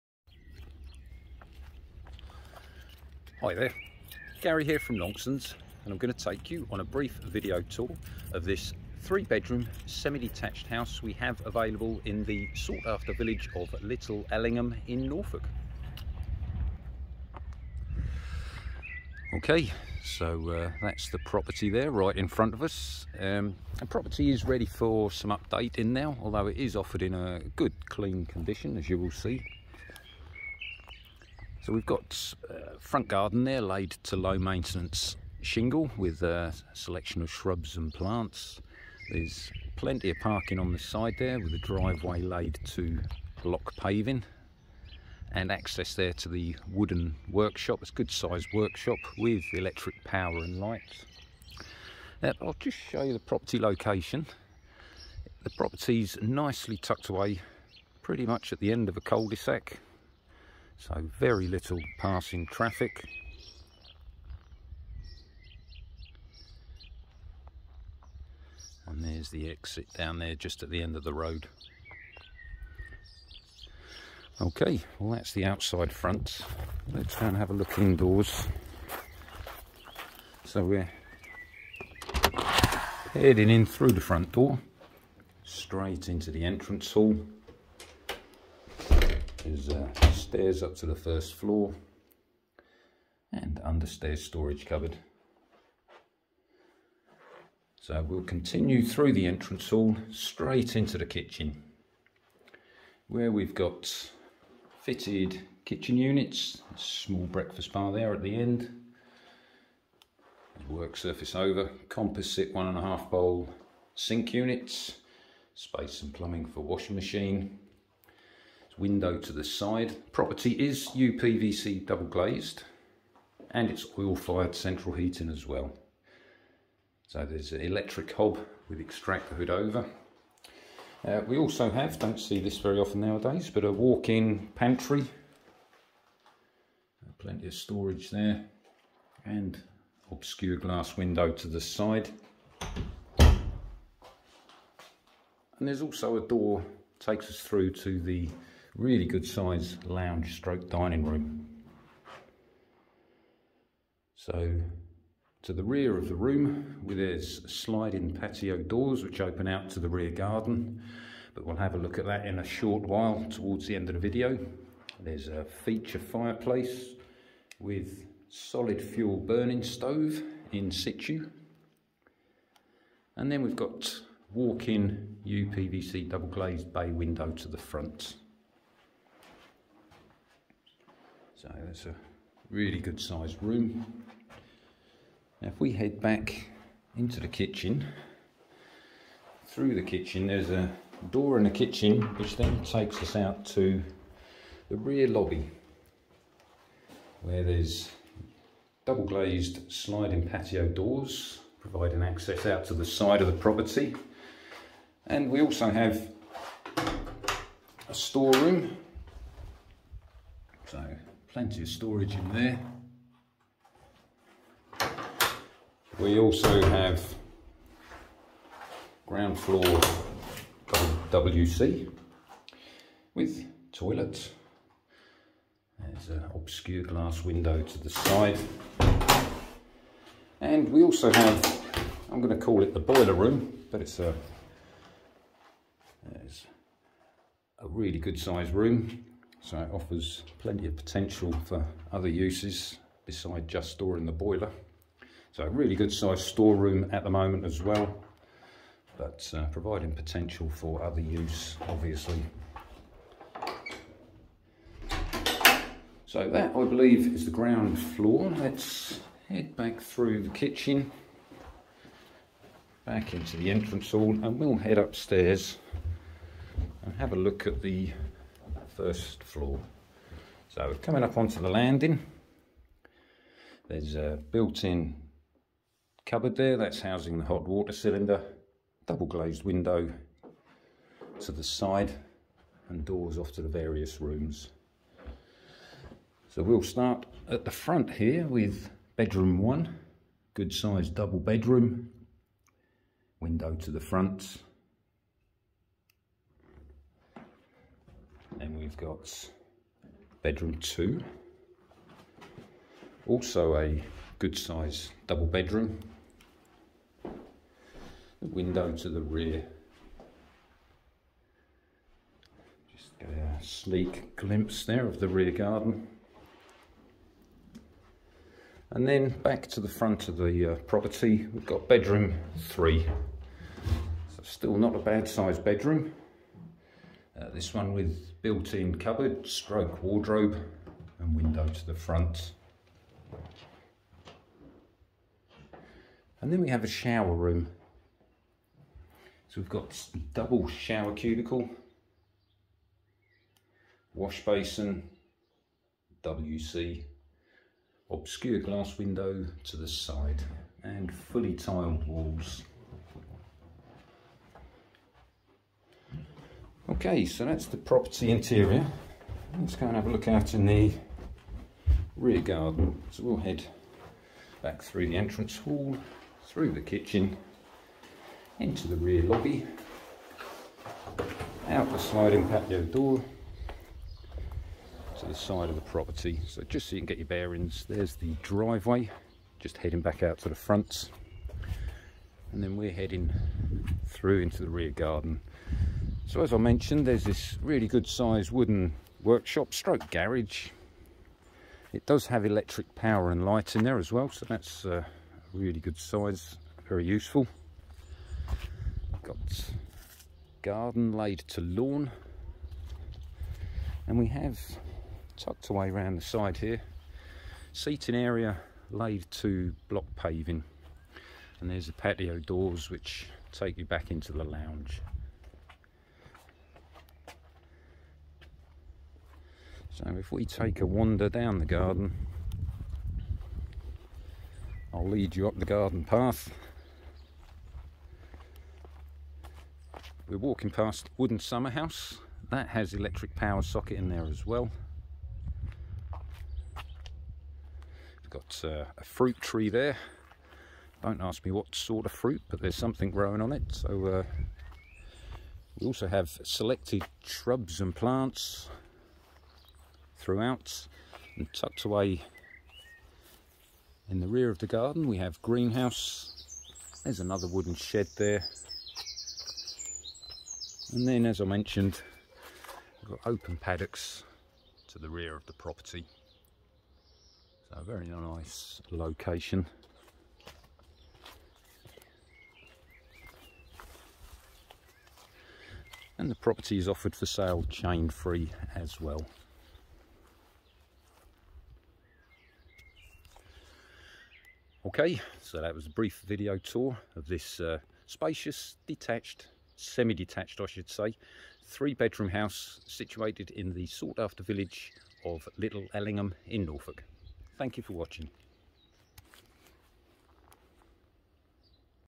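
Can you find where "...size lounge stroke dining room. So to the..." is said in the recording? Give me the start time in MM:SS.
02:29.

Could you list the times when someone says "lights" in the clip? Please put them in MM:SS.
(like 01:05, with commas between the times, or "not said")
00:50, 06:33.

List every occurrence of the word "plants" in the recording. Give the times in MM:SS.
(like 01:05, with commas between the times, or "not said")
00:37, 07:27.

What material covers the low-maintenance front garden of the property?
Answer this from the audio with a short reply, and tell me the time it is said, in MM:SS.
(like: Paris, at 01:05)
Shingle, at 00:35.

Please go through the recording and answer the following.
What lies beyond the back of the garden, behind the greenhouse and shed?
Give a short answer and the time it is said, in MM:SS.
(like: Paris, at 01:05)
Open paddocks, at 07:43.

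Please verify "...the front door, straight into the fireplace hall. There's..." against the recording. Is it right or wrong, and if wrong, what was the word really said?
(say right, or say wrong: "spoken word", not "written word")
wrong: "entrance", not "fireplace".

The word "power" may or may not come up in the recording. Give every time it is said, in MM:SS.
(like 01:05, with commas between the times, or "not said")
00:50, 06:32, 07:13.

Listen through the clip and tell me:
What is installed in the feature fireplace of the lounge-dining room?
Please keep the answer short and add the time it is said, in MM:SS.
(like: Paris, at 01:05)
Solid fuel burning stove, at 02:48.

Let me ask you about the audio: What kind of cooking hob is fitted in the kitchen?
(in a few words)
Electric hob.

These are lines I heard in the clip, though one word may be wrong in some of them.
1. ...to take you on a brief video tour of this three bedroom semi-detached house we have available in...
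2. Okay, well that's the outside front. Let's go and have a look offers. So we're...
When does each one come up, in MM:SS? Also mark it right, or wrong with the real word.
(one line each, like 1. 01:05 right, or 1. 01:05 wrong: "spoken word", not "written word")
1. 00:06 right
2. 01:14 wrong: "indoors", not "offers".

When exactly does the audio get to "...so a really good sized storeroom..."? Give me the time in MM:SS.
04:05.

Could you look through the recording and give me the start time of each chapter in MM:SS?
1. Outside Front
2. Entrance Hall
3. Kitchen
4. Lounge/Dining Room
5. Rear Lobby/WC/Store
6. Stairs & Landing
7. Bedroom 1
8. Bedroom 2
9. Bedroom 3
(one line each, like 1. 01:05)
1. 00:16
2. 01:21
3. 01:39
4. 02:26
5. 03:10
6. 04:24
7. 04:46
8. 04:58
9. 05:18.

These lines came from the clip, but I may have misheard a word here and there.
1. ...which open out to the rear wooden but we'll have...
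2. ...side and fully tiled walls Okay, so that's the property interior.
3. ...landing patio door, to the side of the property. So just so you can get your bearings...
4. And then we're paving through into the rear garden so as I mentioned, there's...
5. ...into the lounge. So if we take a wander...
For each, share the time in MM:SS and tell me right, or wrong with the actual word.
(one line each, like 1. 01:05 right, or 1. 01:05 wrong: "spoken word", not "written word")
1. 02:39 wrong: "garden", not "wooden"
2. 05:49 right
3. 06:11 wrong: "sliding", not "landing"
4. 06:22 wrong: "heading", not "paving"
5. 06:53 right.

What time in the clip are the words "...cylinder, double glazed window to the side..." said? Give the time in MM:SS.
04:37.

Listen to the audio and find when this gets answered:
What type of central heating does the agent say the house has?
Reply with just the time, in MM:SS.
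02:03.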